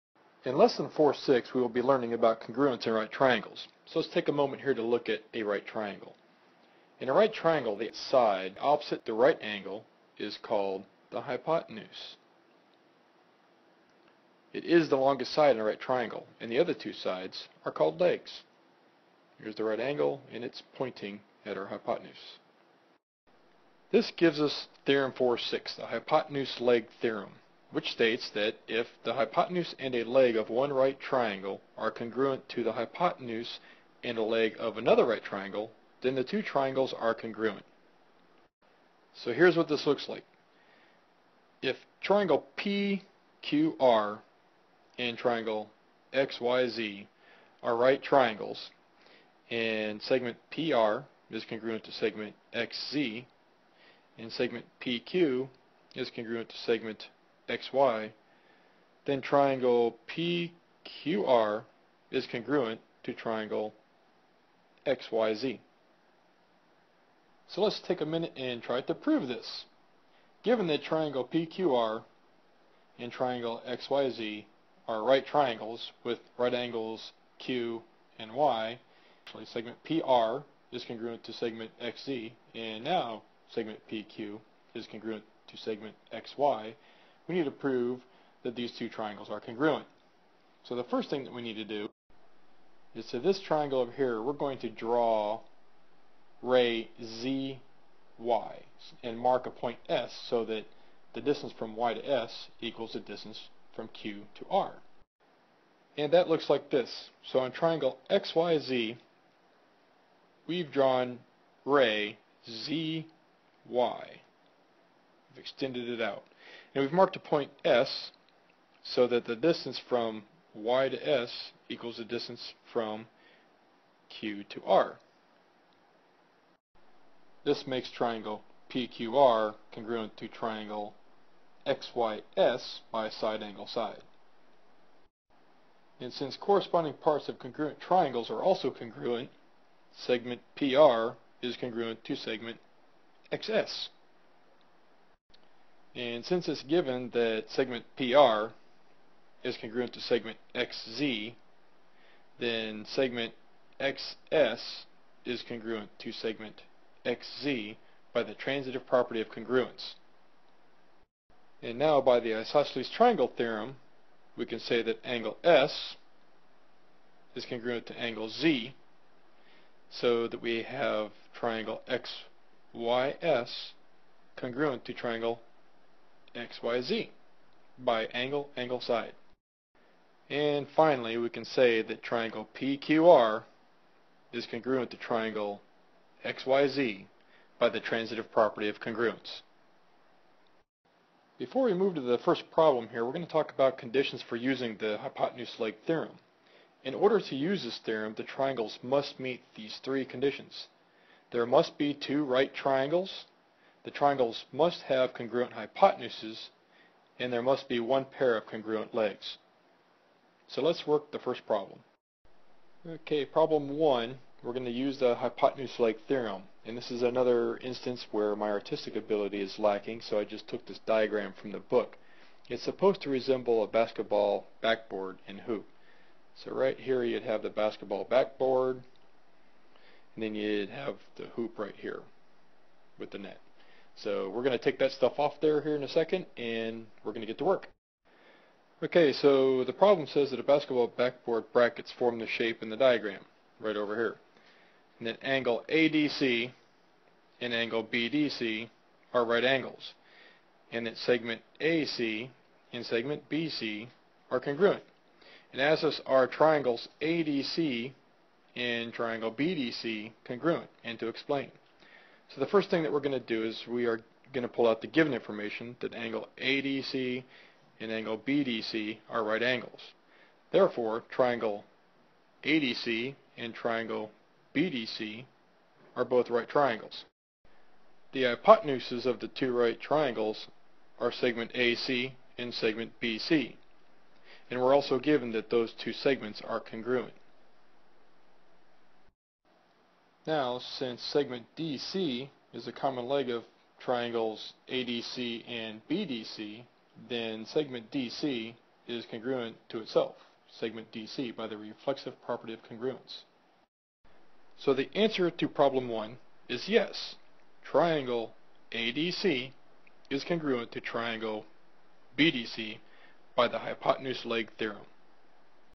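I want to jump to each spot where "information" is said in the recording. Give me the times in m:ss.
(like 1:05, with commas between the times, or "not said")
4:25.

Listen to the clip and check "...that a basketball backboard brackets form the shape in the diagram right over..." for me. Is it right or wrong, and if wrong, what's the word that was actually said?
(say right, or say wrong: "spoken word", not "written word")
right.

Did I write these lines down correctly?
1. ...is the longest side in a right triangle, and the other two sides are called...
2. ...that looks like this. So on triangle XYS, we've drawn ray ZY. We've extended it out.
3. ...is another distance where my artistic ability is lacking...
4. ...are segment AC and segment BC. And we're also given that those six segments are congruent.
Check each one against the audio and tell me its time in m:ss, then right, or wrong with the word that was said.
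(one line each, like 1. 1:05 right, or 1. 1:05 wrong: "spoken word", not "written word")
1. 0:14 right
2. 1:46 wrong: "XYZ", not "XYS"
3. 3:36 wrong: "instance", not "distance"
4. 4:41 wrong: "two", not "six".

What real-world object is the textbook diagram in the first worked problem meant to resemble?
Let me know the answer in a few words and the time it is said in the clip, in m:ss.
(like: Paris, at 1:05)
Basketball backboard and hoop, at 3:43.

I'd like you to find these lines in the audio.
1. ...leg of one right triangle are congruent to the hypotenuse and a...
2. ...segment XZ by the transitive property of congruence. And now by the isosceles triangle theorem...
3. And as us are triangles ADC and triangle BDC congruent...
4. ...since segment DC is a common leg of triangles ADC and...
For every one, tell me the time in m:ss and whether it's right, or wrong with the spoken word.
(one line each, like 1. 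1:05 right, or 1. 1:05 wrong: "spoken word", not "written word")
1. 0:30 right
2. 2:36 right
3. 4:15 right
4. 4:50 right.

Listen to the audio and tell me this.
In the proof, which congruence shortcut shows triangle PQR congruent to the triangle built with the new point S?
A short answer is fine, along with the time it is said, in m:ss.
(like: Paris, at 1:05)
Side angle side, at 2:13.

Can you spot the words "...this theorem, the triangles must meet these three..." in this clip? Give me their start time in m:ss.
3:17.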